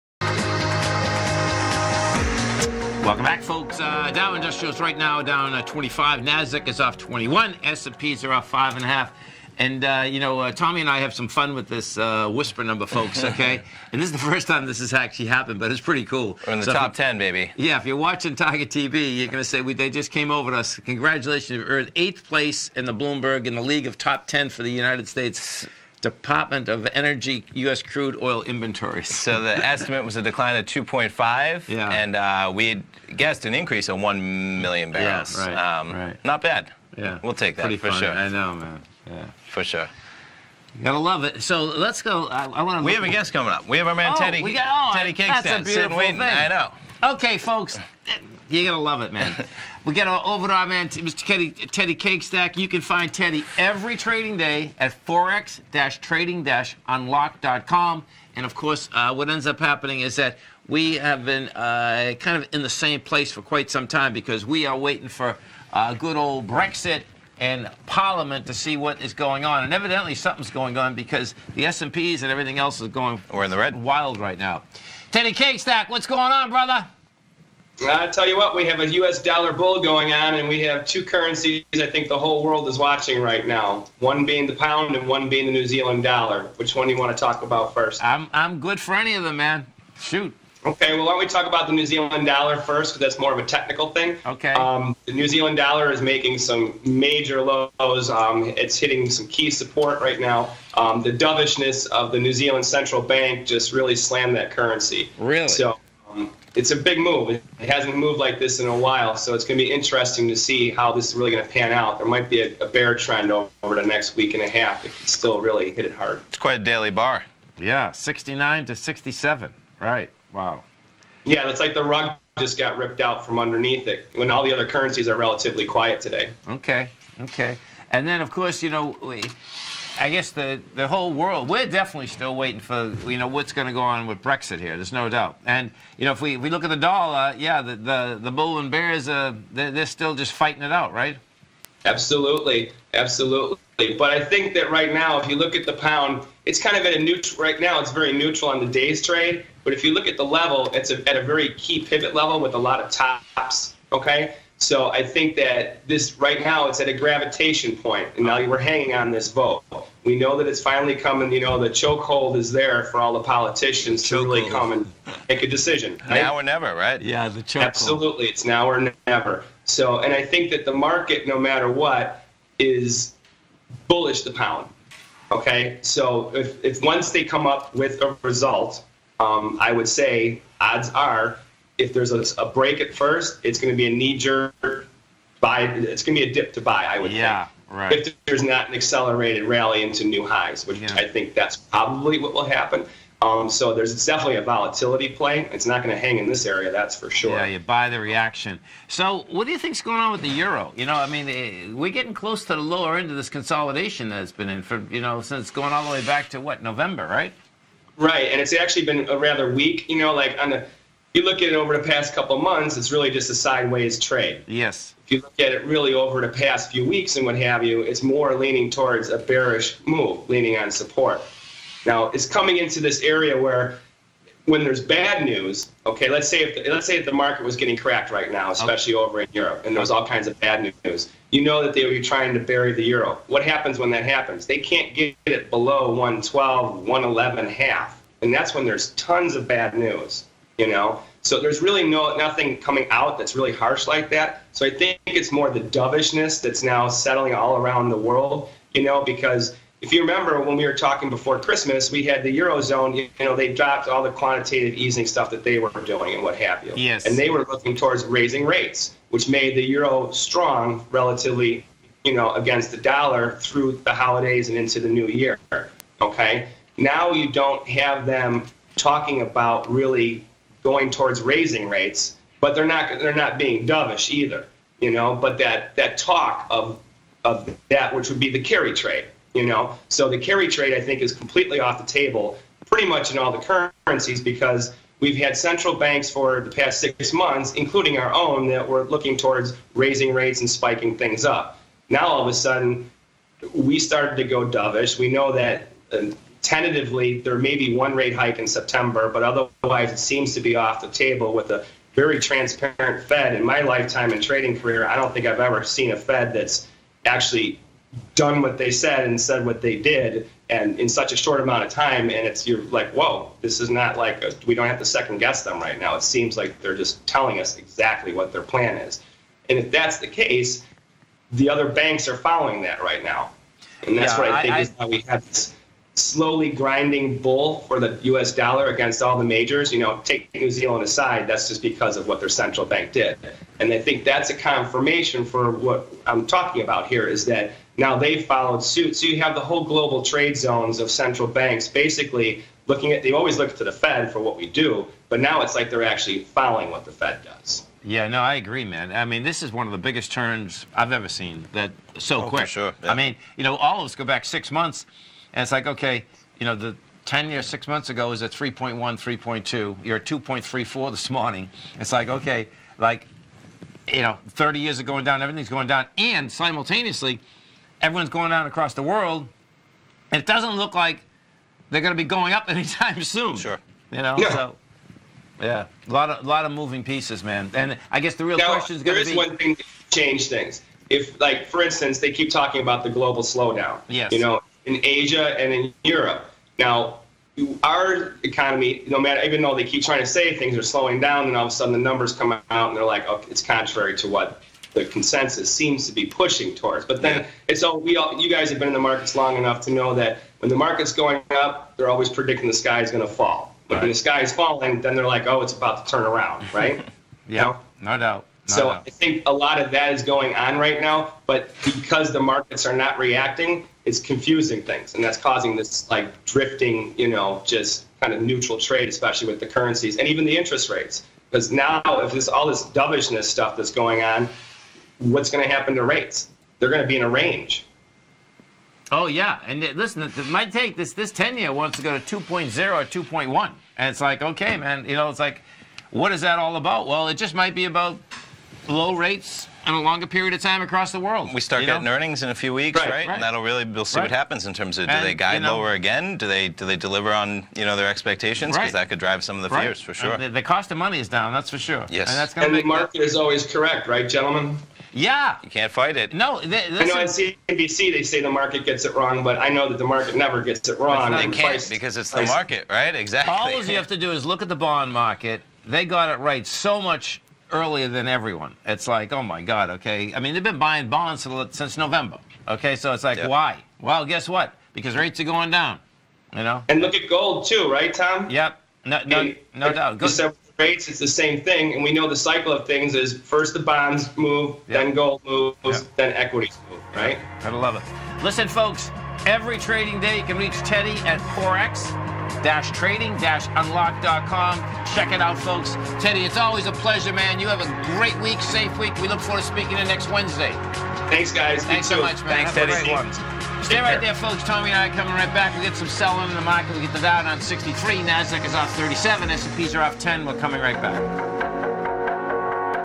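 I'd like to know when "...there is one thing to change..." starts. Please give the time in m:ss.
6:19.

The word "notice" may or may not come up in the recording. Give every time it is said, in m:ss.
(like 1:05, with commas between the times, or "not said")
not said.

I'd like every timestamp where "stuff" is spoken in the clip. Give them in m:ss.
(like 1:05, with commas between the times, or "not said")
4:15, 7:03.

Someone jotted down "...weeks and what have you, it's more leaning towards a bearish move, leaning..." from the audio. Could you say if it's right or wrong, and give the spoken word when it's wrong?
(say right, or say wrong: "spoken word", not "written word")
right.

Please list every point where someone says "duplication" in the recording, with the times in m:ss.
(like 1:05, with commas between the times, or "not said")
not said.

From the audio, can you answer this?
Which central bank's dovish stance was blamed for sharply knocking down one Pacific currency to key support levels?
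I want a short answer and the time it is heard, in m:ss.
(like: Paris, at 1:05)
New Zealand Central Bank, at 1:42.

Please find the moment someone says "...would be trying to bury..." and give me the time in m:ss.
3:51.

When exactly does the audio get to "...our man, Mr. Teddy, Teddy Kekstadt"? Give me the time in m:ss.
0:50.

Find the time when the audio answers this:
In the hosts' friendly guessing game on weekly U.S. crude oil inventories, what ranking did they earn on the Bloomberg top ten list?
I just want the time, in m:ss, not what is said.
0:21.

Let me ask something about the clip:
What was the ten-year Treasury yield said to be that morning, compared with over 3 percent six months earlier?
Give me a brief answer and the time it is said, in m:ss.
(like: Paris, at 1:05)
2.34, at 6:00.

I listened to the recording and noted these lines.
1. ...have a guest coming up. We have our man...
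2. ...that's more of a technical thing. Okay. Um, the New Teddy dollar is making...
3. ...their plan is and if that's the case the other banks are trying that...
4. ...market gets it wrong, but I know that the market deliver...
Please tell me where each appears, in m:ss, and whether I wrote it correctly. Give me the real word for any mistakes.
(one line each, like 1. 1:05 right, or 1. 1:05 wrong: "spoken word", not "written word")
1. 0:42 right
2. 1:33 wrong: "Zealand", not "Teddy"
3. 5:18 wrong: "following", not "trying"
4. 7:38 wrong: "never", not "deliver".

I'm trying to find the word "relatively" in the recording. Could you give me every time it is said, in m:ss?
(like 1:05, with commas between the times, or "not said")
2:05, 4:20.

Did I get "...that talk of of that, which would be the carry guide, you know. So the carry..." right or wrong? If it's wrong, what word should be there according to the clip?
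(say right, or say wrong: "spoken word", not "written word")
wrong: "trade", not "guide".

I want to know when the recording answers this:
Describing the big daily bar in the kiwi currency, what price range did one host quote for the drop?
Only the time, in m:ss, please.
1:57.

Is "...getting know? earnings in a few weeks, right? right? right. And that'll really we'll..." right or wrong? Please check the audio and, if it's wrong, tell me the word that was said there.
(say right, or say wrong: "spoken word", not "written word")
right.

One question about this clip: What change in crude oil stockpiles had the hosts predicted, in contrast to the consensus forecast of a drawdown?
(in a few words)
an increase of 1 million barrels.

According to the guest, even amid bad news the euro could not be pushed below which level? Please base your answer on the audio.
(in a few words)
112.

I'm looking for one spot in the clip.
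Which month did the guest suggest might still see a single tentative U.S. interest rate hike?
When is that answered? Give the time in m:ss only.
4:58.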